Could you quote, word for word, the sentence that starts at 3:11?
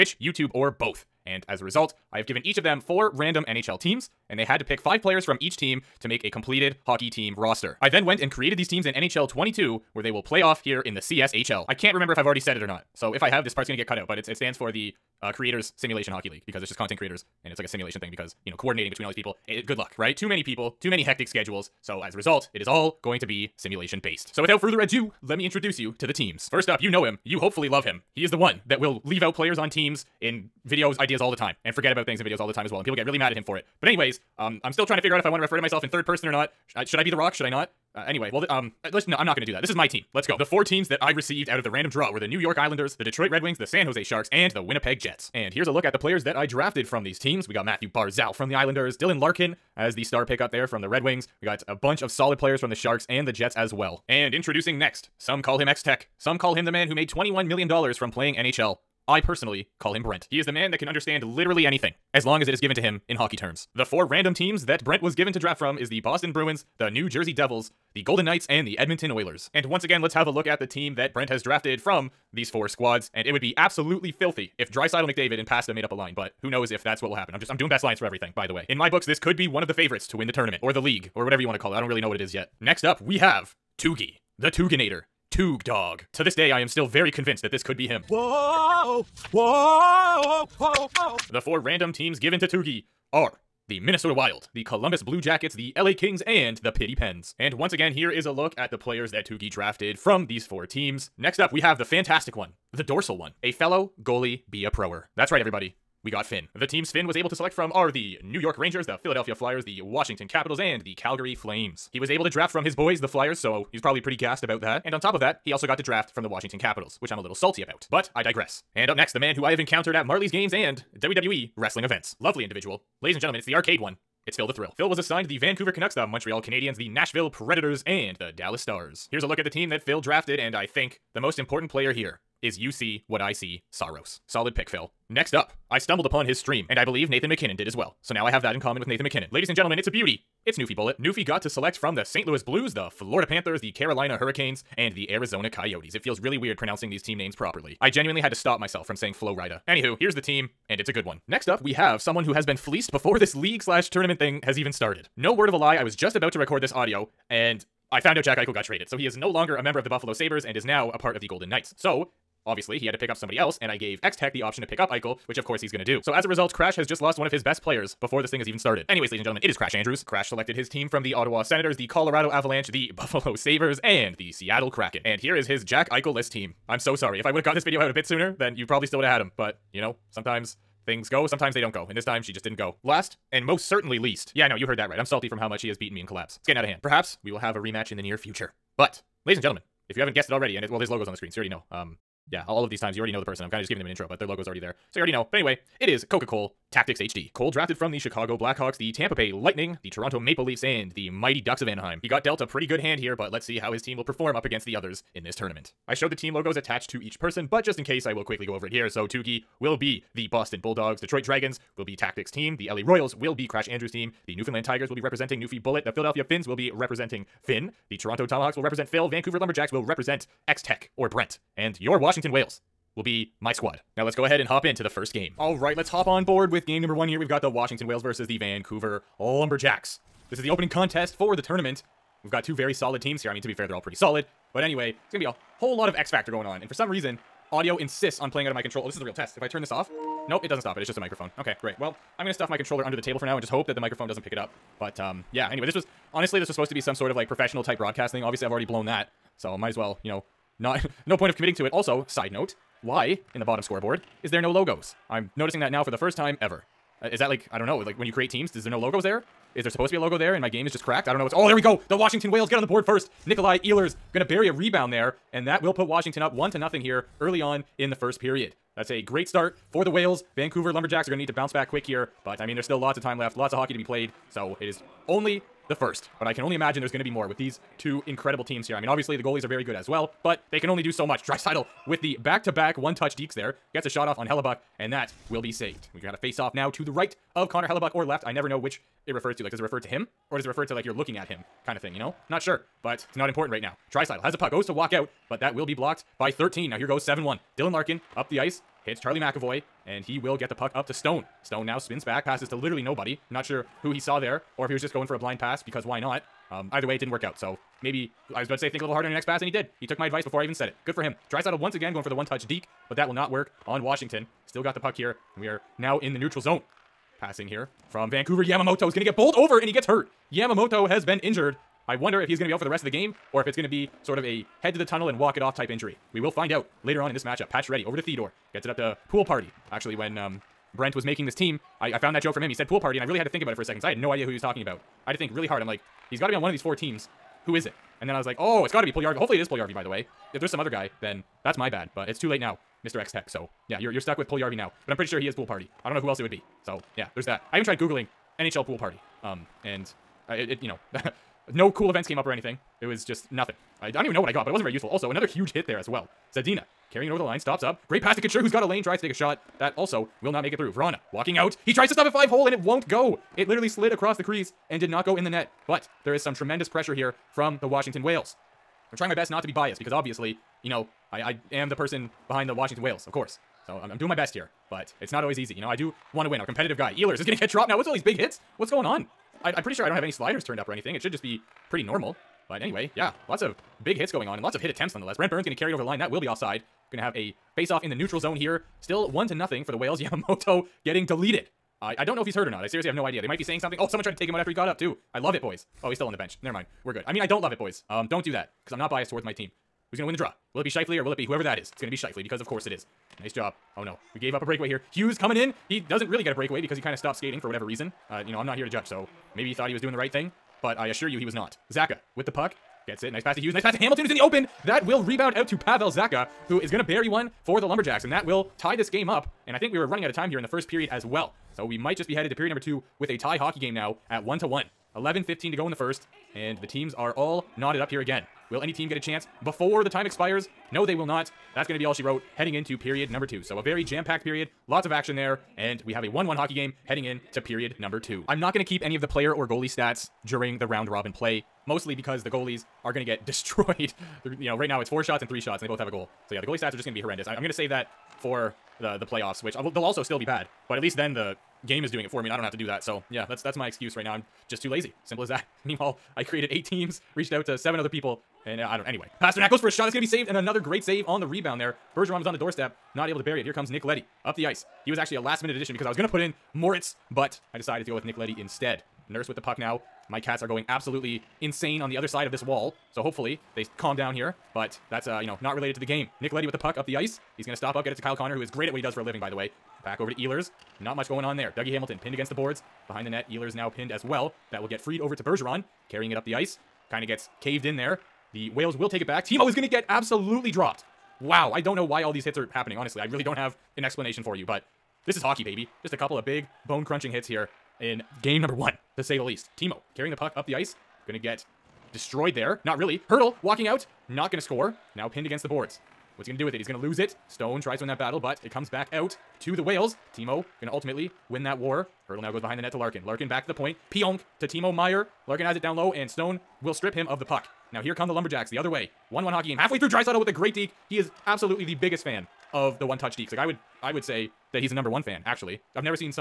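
Um, yeah, all of these times you already know the person.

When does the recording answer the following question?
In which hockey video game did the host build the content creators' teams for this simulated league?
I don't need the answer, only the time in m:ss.
0:08.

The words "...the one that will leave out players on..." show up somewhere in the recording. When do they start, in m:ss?
0:28.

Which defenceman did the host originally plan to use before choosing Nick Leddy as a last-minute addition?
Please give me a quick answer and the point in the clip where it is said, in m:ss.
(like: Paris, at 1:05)
Moritz, at 7:46.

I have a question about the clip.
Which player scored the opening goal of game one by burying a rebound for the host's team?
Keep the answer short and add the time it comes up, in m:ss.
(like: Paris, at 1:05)
Nikolai Ehlers, at 4:23.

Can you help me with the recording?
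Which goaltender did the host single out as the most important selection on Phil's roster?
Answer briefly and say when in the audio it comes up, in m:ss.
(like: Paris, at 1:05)
Saros, at 2:13.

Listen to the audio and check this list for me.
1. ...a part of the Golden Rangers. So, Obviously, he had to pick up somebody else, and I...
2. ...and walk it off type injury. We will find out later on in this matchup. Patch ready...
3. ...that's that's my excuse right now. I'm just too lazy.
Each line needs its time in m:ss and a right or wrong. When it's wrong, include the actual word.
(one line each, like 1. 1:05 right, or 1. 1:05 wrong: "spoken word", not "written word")
1. 2:40 wrong: "Knights", not "Rangers"
2. 5:25 right
3. 7:33 right.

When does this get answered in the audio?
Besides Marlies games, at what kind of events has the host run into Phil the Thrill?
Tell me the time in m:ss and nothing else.
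2:00.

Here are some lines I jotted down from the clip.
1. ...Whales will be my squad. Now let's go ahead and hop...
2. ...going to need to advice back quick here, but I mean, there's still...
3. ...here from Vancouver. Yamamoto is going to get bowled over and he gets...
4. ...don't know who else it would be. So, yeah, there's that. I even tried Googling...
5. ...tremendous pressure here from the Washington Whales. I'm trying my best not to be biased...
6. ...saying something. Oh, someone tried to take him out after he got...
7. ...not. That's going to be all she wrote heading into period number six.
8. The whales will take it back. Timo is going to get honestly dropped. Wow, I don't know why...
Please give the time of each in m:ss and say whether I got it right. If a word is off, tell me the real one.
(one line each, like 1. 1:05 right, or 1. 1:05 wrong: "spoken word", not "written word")
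1. 3:42 right
2. 4:31 wrong: "bounce", not "advice"
3. 5:17 right
4. 5:45 right
5. 6:06 right
6. 6:33 right
7. 7:11 wrong: "two", not "six"
8. 8:08 wrong: "absolutely", not "honestly".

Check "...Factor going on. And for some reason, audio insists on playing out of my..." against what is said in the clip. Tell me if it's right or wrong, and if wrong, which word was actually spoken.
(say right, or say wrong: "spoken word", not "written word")
right.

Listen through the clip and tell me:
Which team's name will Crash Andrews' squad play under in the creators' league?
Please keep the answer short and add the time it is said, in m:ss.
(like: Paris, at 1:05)
LA Royals, at 3:32.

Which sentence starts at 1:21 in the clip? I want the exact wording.
I don't really know what it is yet.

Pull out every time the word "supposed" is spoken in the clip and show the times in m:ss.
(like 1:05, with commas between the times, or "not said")
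4:06, 4:19.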